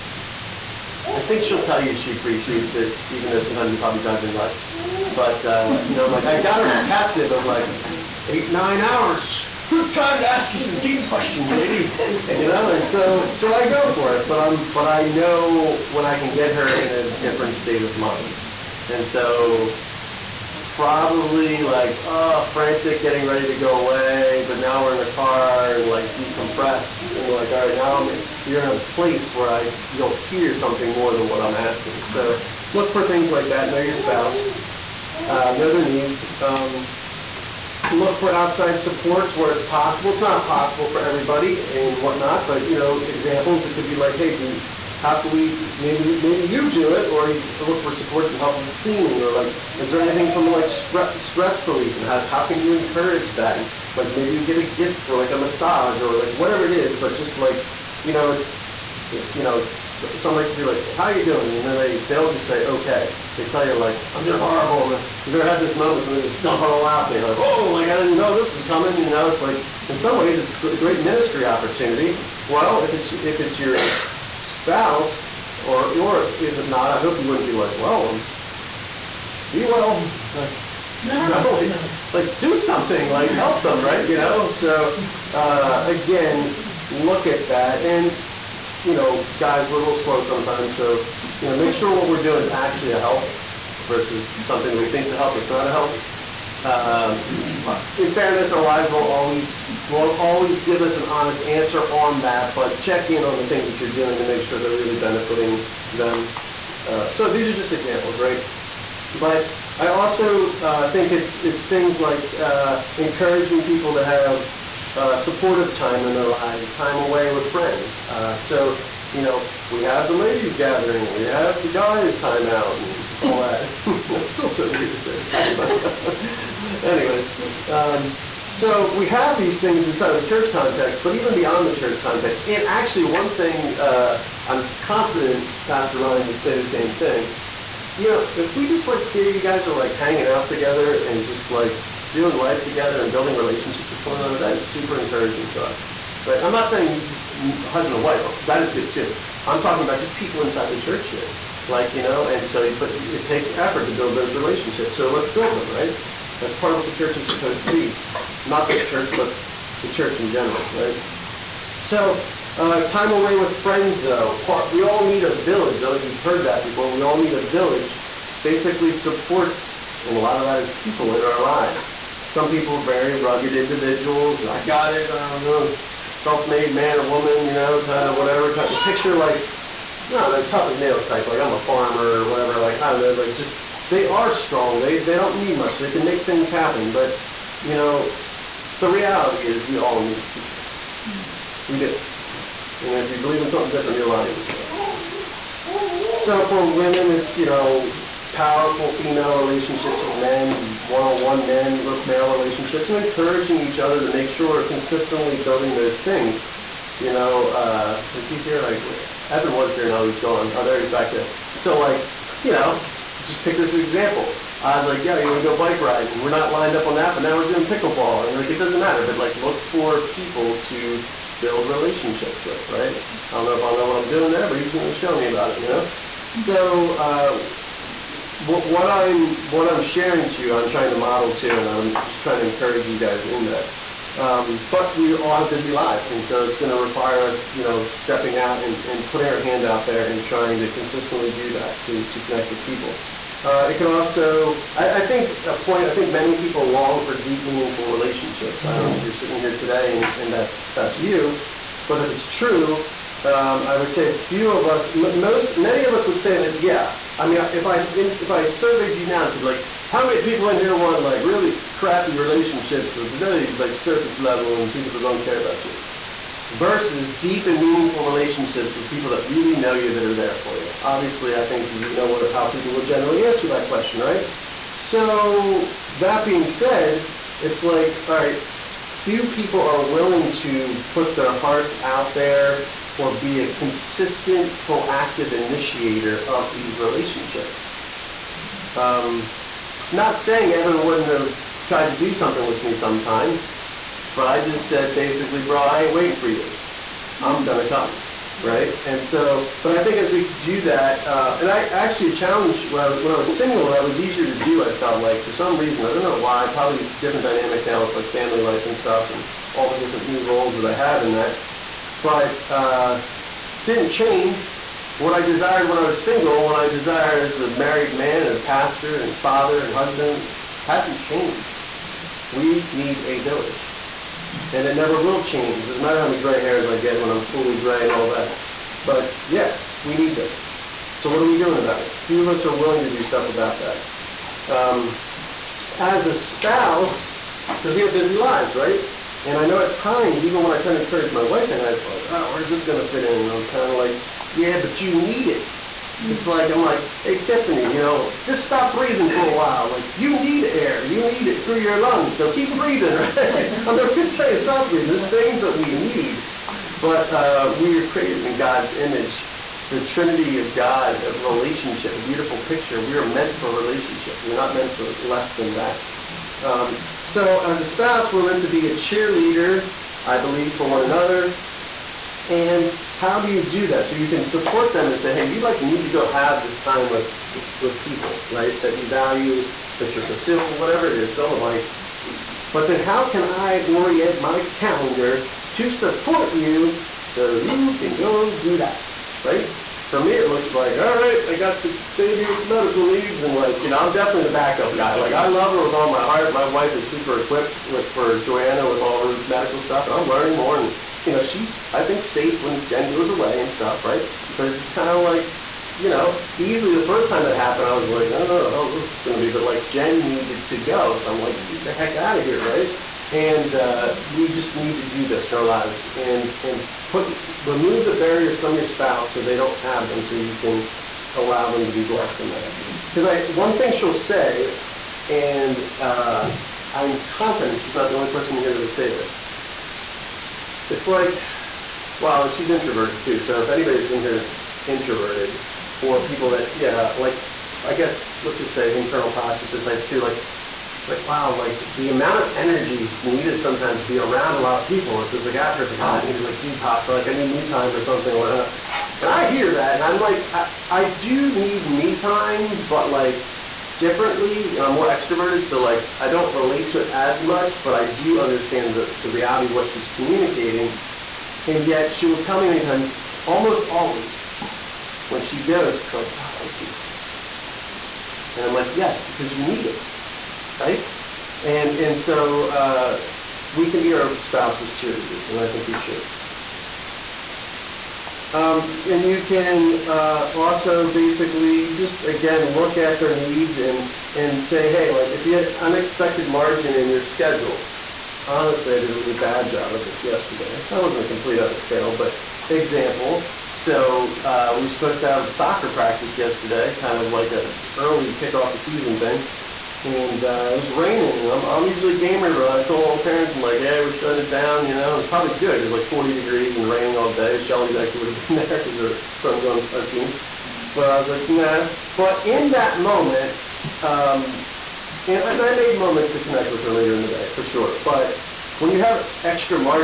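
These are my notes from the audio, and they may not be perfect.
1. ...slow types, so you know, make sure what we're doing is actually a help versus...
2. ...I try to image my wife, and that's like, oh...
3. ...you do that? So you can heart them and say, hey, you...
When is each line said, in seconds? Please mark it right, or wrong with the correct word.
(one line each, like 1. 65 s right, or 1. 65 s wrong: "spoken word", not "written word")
1. 89 s wrong: "sometimes", not "types"
2. 340 s wrong: "encourage", not "image"
3. 373 s wrong: "support", not "heart".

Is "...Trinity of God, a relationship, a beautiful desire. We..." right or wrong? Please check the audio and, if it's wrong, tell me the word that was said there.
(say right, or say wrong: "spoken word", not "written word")
wrong: "picture", not "desire".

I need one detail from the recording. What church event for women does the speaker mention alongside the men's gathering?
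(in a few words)
ladies gathering.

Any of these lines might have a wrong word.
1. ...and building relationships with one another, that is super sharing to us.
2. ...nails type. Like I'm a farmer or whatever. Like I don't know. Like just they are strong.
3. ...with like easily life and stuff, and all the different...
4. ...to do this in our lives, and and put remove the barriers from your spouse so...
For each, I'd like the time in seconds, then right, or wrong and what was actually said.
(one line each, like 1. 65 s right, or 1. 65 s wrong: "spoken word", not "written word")
1. 143 s wrong: "encouraging", not "sharing"
2. 180 s right
3. 307 s wrong: "family", not "easily"
4. 414 s right.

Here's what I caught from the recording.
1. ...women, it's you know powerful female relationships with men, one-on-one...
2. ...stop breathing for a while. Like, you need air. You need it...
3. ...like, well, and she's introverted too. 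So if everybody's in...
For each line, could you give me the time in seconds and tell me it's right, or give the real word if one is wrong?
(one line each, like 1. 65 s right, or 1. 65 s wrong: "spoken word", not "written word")
1. 196 s right
2. 348 s right
3. 430 s wrong: "anybody", not "everybody".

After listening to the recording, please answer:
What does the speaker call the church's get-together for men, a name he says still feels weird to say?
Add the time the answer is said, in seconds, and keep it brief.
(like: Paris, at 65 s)
guys time out, at 121 s.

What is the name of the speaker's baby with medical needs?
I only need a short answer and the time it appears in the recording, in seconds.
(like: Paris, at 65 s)
Joanna, at 398 s.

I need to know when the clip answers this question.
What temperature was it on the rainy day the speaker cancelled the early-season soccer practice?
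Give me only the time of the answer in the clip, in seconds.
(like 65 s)
505 s.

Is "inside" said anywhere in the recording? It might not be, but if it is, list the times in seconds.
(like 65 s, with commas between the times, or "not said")
129 s, 150 s.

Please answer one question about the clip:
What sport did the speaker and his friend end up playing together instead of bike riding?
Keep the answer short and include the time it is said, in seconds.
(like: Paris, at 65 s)
pickleball, at 217 s.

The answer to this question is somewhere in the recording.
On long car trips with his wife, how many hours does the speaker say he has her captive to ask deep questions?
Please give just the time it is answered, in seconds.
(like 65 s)
8 s.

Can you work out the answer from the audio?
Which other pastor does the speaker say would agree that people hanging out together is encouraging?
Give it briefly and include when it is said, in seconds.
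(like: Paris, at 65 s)
Pastor Ryan, at 135 s.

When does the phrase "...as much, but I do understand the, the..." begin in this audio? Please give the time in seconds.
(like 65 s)
456 s.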